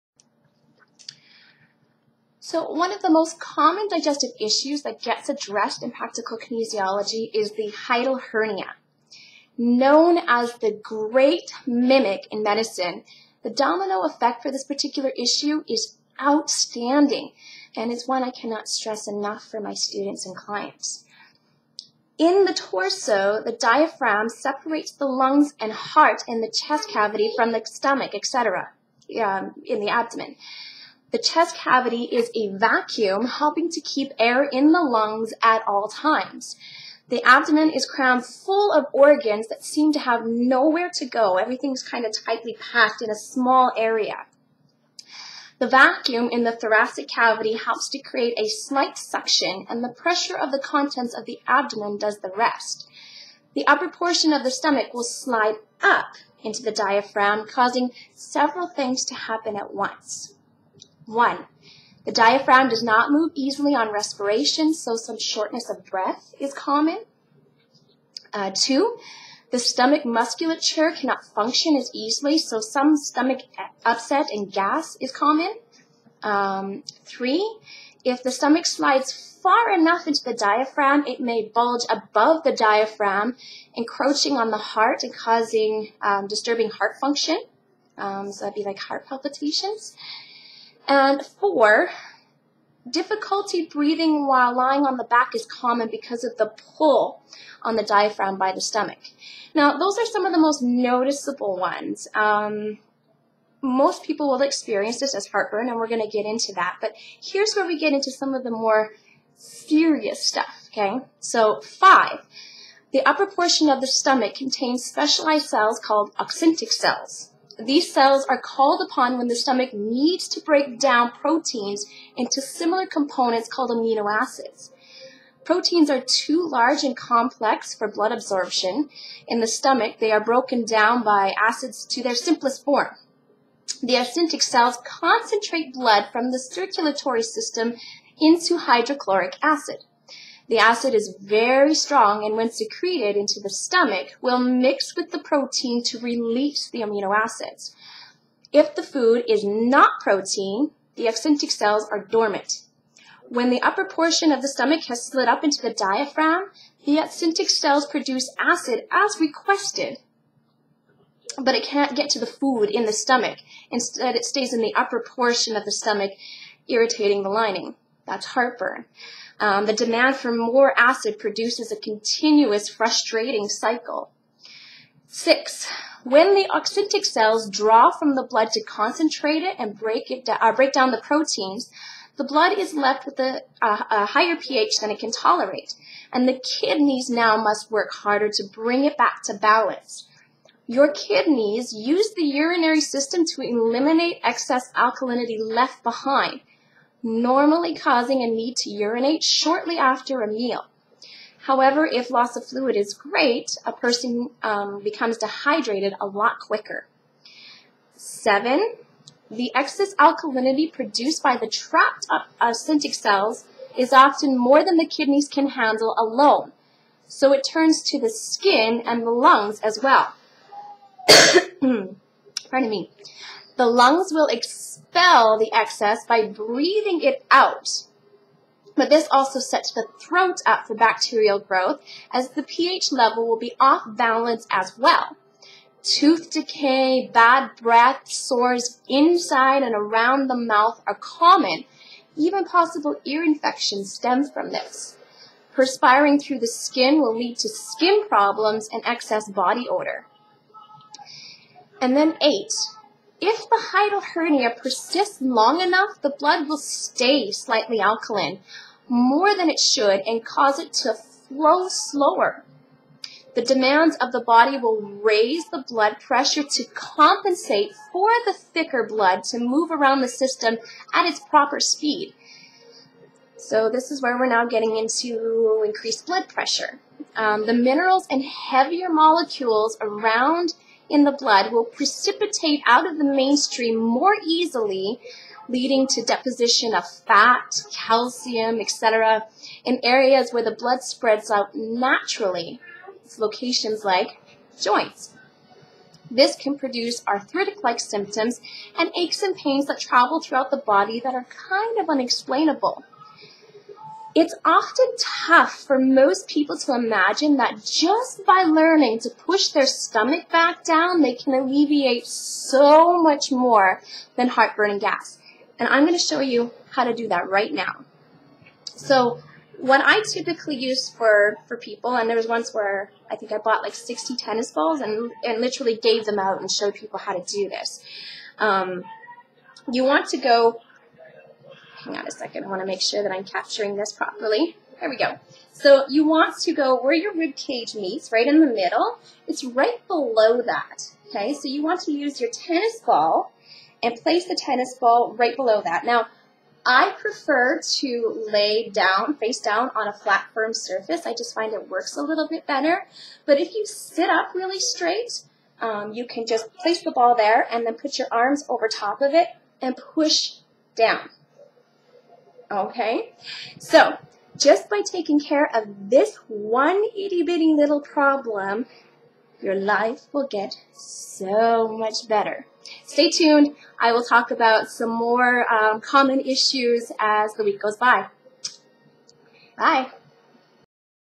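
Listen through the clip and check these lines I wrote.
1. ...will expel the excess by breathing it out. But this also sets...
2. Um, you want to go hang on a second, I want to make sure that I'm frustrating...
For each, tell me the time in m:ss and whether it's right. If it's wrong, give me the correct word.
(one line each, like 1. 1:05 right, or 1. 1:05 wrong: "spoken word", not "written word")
1. 3:44 right
2. 5:28 wrong: "capturing", not "frustrating".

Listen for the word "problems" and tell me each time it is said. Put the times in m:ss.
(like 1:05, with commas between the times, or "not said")
4:08, 6:07.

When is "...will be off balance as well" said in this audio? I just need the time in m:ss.
3:53.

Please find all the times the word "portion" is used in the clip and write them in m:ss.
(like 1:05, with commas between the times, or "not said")
0:53, 1:53, 2:33, 2:45.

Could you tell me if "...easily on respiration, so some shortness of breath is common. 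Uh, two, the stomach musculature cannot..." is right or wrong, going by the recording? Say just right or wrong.
right.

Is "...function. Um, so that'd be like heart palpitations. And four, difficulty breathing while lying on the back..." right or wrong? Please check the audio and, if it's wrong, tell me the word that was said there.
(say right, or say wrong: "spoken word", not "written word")
right.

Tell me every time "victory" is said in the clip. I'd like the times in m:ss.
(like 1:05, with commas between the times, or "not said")
not said.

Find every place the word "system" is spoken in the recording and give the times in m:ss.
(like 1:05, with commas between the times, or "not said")
2:17, 3:12, 4:30.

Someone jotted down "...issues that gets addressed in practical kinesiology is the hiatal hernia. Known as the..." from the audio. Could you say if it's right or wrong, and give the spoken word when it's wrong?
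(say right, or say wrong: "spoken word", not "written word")
right.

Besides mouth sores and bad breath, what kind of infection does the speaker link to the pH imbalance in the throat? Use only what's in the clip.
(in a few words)
Ear infections.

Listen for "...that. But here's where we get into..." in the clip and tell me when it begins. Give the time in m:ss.
1:46.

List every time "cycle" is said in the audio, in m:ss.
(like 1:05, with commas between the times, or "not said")
2:53.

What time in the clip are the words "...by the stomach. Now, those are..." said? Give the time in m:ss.
1:38.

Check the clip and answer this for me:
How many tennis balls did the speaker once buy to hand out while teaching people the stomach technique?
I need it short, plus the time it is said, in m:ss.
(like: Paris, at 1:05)
60, at 5:23.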